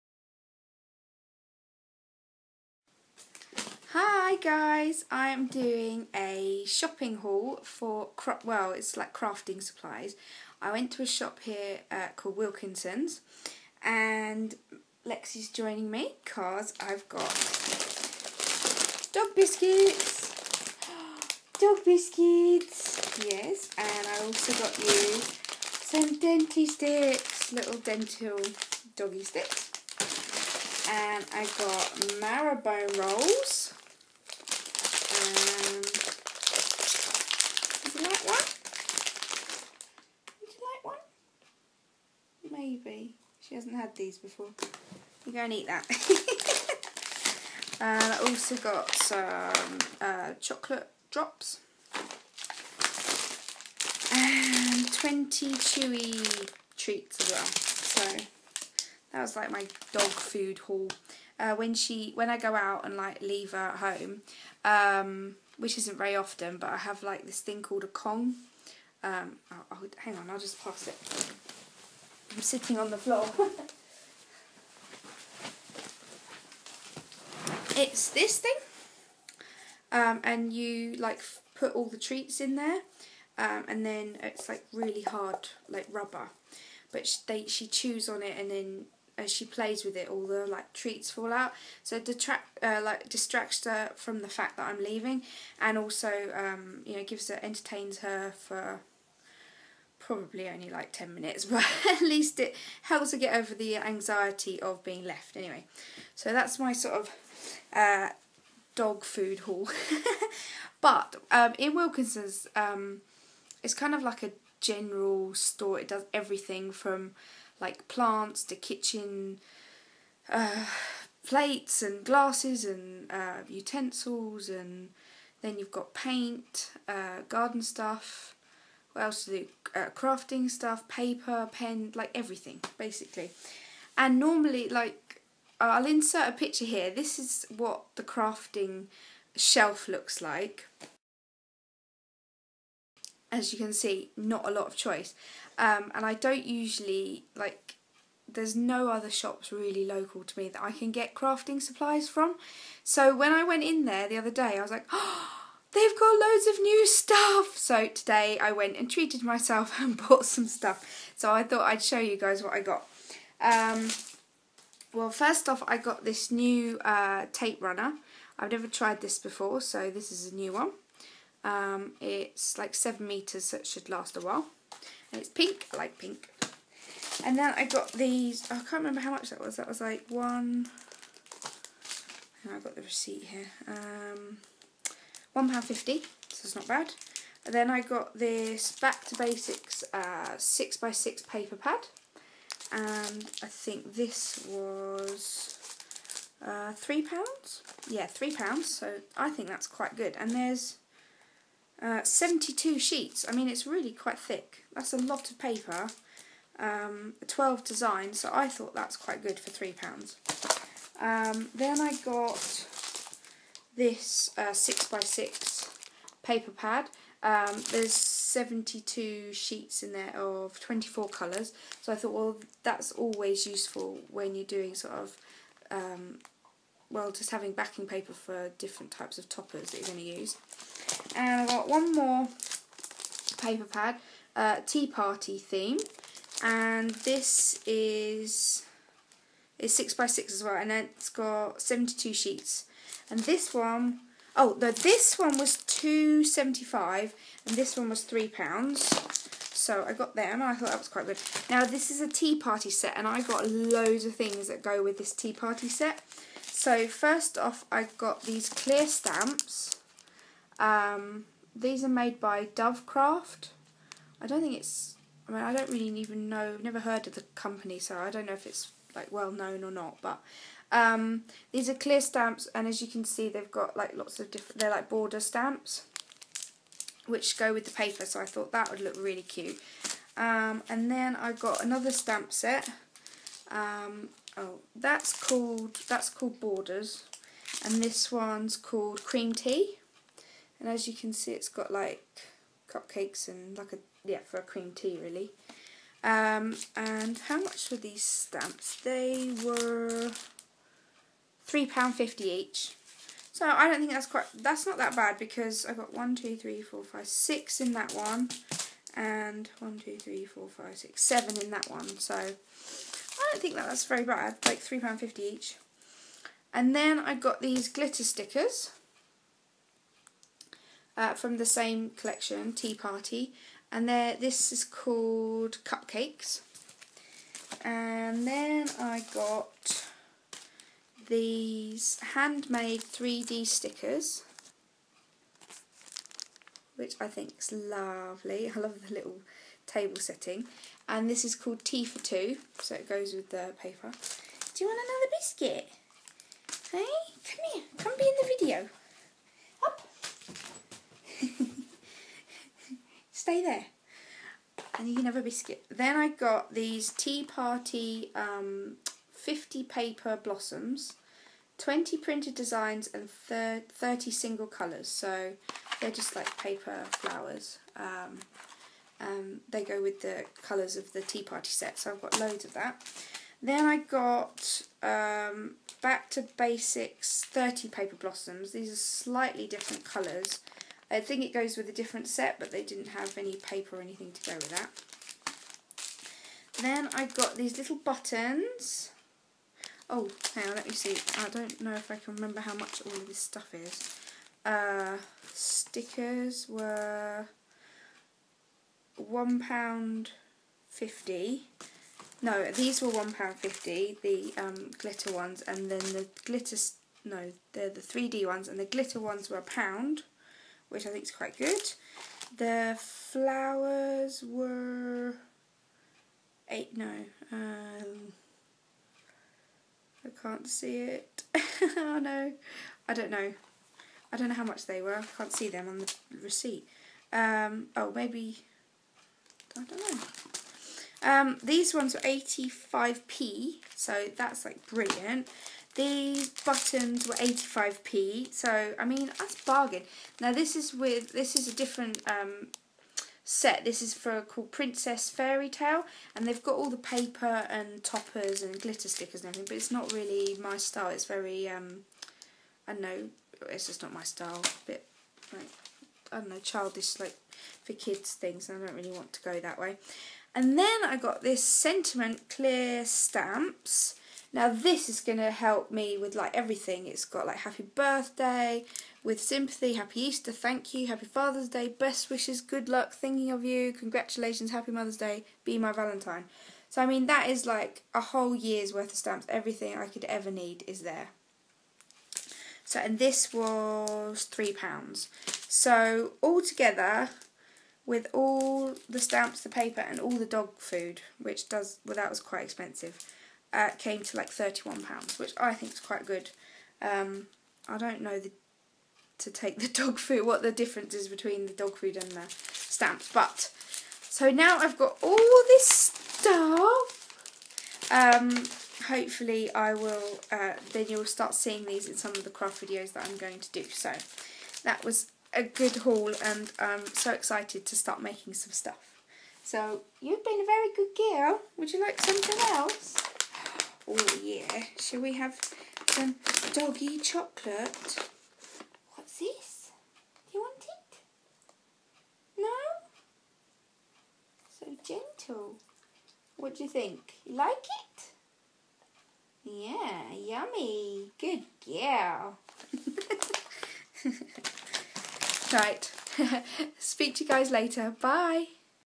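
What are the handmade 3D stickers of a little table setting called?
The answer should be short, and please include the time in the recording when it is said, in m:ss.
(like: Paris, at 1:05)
Tea for Two, at 5:41.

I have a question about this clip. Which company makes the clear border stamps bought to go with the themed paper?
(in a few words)
Dovecraft.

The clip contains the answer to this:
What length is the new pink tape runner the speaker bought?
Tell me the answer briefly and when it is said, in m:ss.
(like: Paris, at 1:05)
7 metres, at 2:52.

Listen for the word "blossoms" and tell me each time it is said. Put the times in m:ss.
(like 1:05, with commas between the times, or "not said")
6:00, 6:17.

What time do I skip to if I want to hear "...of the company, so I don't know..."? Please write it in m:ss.
4:27.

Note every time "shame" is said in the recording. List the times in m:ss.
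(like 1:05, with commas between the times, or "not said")
not said.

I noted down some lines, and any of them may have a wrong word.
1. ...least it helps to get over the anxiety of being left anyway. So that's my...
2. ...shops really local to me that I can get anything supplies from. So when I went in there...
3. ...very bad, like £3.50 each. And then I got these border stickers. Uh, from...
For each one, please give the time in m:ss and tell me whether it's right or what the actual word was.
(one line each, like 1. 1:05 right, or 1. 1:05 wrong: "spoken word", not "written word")
1. 1:42 right
2. 2:29 wrong: "crafting", not "anything"
3. 5:13 wrong: "glitter", not "border".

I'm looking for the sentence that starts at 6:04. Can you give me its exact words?
So they're just like paper flowers.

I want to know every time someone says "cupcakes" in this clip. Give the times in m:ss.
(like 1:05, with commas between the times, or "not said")
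4:52, 5:25.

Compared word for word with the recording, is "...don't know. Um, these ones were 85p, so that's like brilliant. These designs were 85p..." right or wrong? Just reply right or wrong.
wrong.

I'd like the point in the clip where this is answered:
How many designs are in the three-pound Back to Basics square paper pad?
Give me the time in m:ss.
3:27.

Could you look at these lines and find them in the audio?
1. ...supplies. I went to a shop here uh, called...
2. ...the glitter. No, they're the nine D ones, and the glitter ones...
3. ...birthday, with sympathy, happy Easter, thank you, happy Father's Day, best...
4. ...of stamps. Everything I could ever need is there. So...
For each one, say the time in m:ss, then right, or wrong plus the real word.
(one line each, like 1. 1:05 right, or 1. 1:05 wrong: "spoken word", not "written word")
1. 0:09 right
2. 6:45 wrong: "three", not "nine"
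3. 7:47 right
4. 7:58 right.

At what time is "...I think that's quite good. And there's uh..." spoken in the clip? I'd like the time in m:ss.
3:19.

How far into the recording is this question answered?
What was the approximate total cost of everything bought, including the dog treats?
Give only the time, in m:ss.
8:14.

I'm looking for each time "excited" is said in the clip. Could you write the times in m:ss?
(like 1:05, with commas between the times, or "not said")
8:37.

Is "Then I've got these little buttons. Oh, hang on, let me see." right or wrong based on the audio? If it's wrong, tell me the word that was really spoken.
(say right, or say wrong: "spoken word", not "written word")
right.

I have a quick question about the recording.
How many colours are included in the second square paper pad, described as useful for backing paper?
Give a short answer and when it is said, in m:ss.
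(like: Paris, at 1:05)
24, at 3:40.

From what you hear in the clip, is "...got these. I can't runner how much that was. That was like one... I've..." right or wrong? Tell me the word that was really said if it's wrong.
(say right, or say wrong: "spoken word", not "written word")
wrong: "remember", not "runner".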